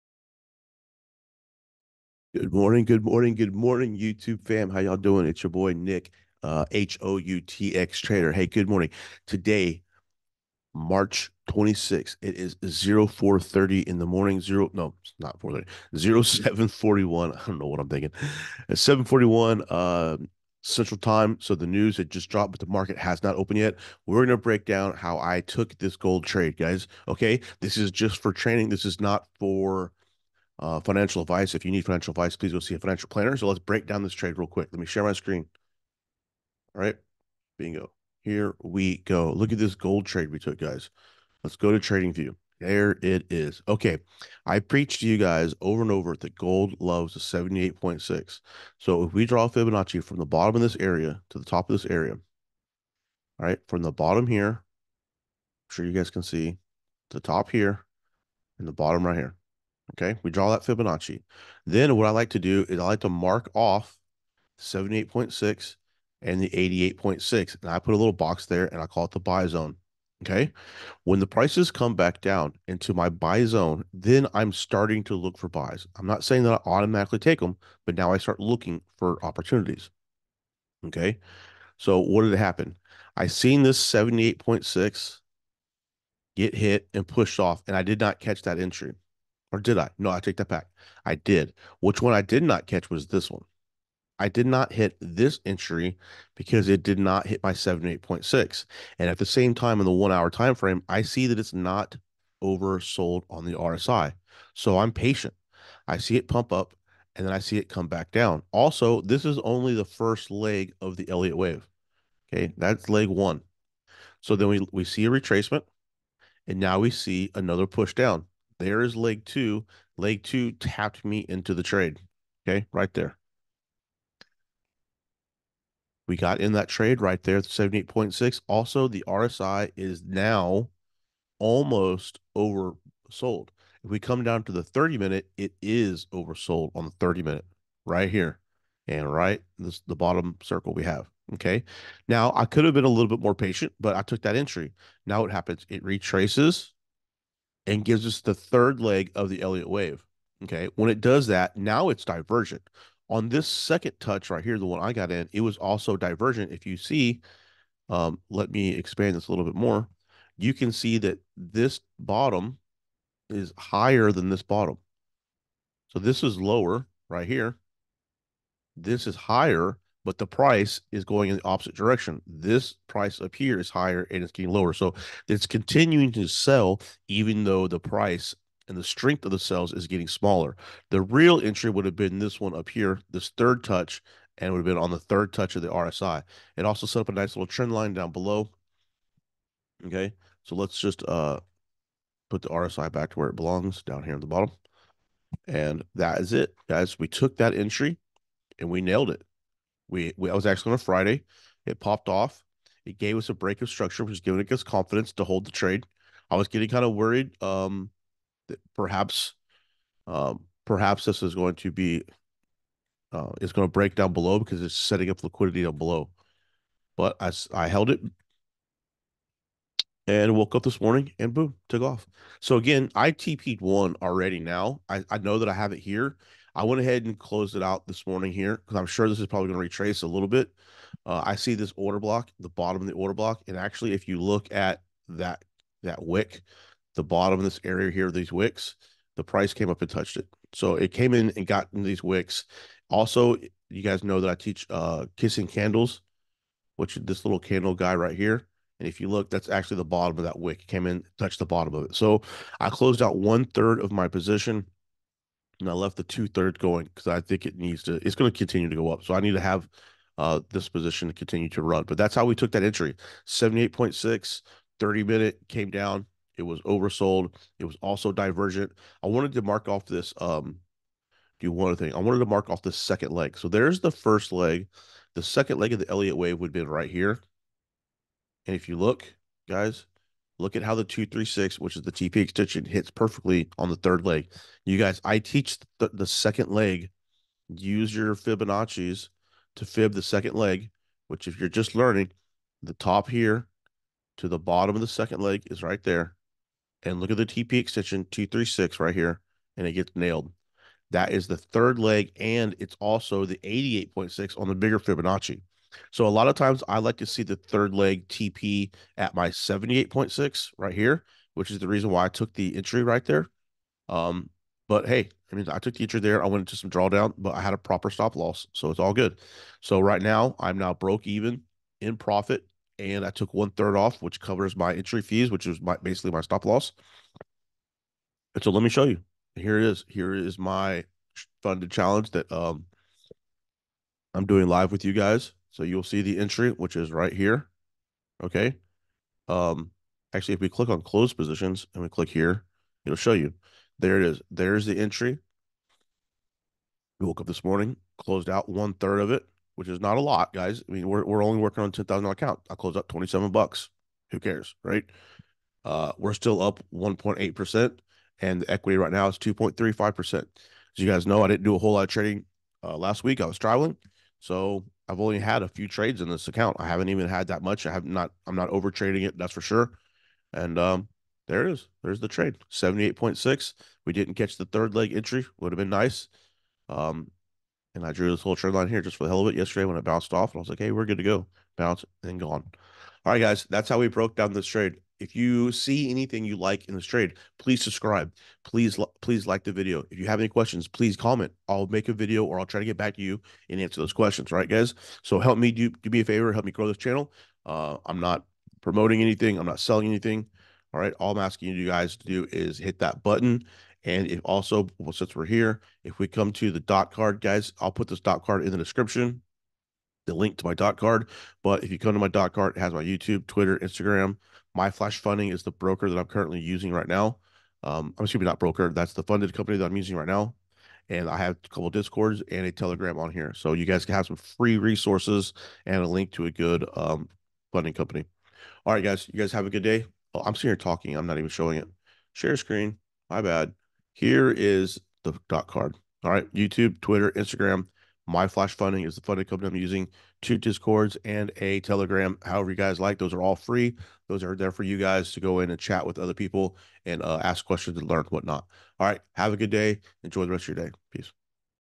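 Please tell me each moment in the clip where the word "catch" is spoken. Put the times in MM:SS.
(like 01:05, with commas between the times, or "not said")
01:28, 01:32, 06:14.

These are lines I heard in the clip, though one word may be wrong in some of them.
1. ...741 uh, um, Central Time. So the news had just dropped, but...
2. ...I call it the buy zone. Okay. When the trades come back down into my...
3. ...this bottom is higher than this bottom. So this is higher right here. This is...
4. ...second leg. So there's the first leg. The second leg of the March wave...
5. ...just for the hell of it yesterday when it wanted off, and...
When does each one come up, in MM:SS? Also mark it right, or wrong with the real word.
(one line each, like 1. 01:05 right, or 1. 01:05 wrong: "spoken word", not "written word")
1. 00:18 right
2. 01:08 wrong: "prices", not "trades"
3. 02:41 wrong: "lower", not "higher"
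4. 04:32 wrong: "Elliott", not "March"
5. 06:18 wrong: "bounced", not "wanted".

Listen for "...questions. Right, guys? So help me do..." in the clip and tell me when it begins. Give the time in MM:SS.
06:33.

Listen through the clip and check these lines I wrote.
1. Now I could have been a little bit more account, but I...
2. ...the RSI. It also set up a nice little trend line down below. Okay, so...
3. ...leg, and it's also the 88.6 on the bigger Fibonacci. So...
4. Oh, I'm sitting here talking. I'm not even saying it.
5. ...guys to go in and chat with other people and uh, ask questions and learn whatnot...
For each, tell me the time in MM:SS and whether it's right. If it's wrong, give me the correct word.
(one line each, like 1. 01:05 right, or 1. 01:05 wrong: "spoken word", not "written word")
1. 02:22 wrong: "patient", not "account"
2. 03:05 right
3. 05:01 right
4. 07:10 wrong: "showing", not "saying"
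5. 07:24 right.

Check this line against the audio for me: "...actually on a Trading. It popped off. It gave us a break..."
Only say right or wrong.
wrong.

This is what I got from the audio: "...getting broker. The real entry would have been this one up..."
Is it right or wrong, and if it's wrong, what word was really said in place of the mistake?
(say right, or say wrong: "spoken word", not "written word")
wrong: "smaller", not "broker".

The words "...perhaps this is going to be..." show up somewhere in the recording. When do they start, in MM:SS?
03:30.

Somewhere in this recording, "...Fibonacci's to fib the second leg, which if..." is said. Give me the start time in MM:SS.
04:48.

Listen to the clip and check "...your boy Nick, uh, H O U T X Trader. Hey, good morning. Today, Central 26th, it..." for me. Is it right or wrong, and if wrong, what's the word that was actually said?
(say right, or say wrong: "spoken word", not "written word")
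wrong: "March", not "Central".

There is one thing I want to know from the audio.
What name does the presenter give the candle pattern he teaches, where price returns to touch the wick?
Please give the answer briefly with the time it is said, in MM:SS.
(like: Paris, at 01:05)
kissing candles, at 04:05.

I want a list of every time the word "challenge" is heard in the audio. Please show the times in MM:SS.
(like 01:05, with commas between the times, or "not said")
05:31.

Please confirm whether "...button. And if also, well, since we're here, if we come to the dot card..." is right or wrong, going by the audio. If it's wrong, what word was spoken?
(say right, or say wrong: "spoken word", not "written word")
right.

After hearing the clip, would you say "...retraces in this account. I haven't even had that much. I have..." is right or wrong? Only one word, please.
wrong.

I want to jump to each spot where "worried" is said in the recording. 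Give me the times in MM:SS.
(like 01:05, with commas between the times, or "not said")
03:26.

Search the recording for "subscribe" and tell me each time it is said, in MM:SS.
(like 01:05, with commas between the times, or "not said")
06:27.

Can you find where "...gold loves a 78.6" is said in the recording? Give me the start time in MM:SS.
00:46.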